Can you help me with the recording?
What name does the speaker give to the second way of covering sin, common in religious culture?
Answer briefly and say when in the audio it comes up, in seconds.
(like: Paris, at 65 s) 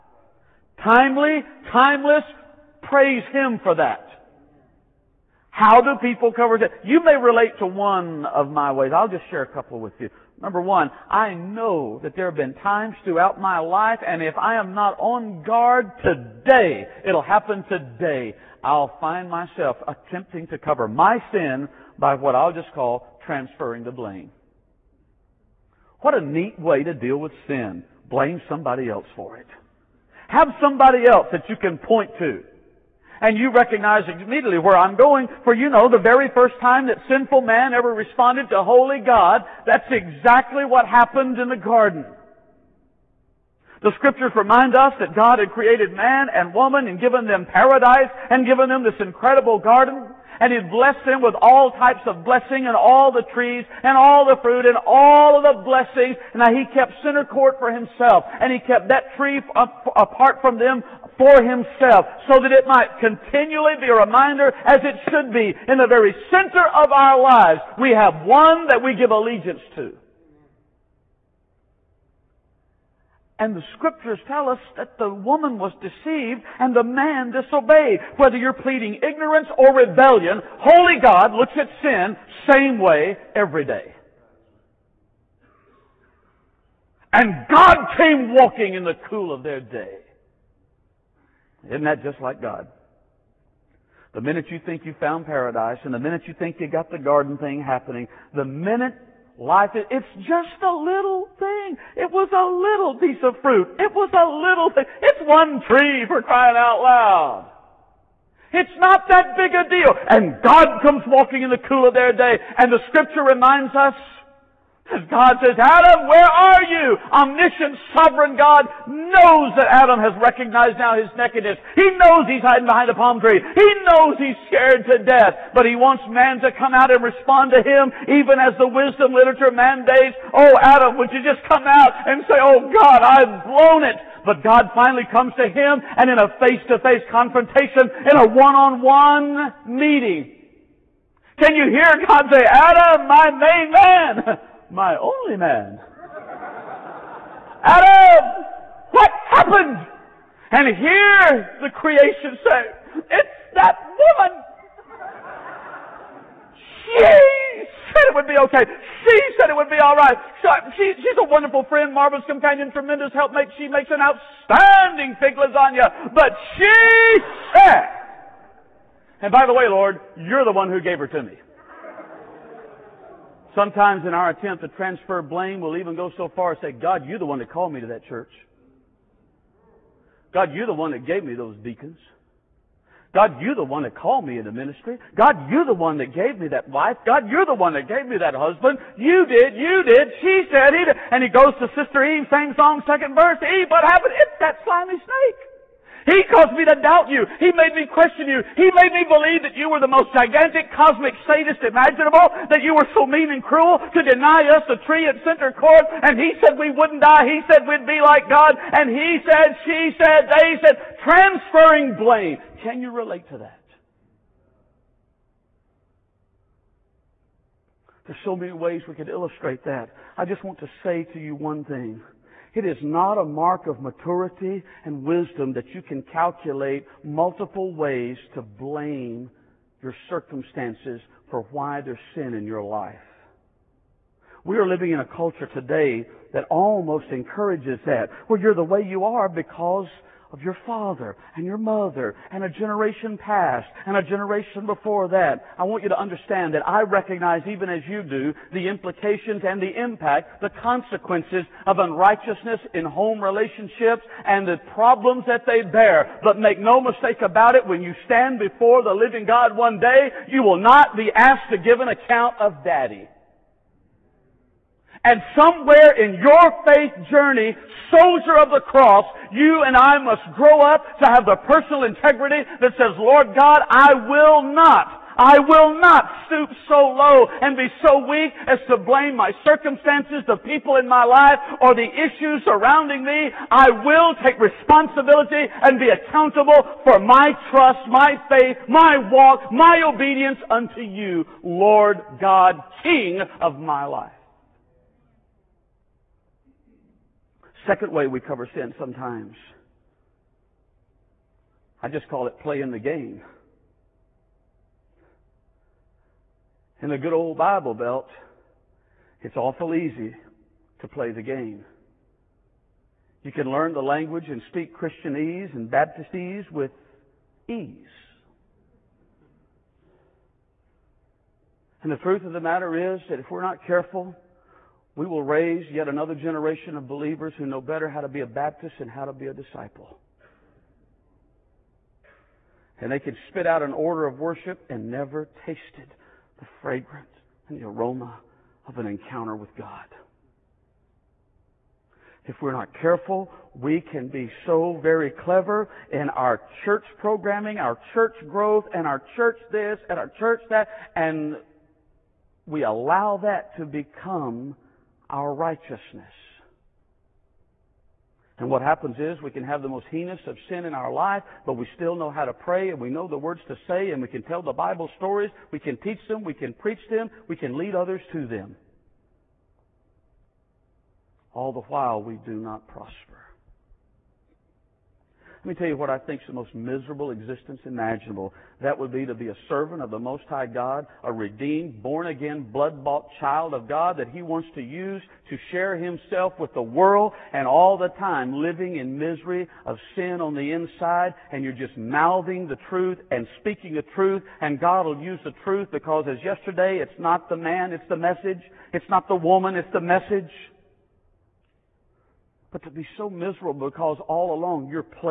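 Playing the game, at 302 s.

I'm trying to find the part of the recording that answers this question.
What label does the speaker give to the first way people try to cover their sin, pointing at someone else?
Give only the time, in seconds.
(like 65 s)
23 s.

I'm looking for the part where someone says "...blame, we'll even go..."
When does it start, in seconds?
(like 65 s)
175 s.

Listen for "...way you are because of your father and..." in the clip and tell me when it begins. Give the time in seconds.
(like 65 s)
238 s.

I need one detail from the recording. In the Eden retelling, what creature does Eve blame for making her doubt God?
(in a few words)
Snake.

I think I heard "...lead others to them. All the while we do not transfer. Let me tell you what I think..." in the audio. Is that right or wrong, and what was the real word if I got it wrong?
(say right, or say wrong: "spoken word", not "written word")
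wrong: "prosper", not "transfer".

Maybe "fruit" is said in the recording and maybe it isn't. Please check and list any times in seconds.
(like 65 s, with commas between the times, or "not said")
54 s, 103 s.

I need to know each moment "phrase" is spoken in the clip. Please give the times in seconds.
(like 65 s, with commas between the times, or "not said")
not said.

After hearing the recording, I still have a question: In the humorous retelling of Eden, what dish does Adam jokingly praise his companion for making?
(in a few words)
Fig lasagna.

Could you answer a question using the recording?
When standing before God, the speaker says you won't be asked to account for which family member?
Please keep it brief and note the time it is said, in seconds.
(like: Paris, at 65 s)
Daddy, at 262 s.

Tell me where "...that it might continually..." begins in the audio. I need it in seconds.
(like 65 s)
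62 s.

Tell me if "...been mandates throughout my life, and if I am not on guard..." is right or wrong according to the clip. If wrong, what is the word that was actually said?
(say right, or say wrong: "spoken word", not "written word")
wrong: "times", not "mandates".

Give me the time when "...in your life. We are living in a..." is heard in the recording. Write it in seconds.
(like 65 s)
232 s.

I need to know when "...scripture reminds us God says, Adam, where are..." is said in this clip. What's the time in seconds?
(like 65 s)
112 s.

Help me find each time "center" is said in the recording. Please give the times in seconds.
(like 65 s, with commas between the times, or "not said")
57 s, 66 s, 205 s.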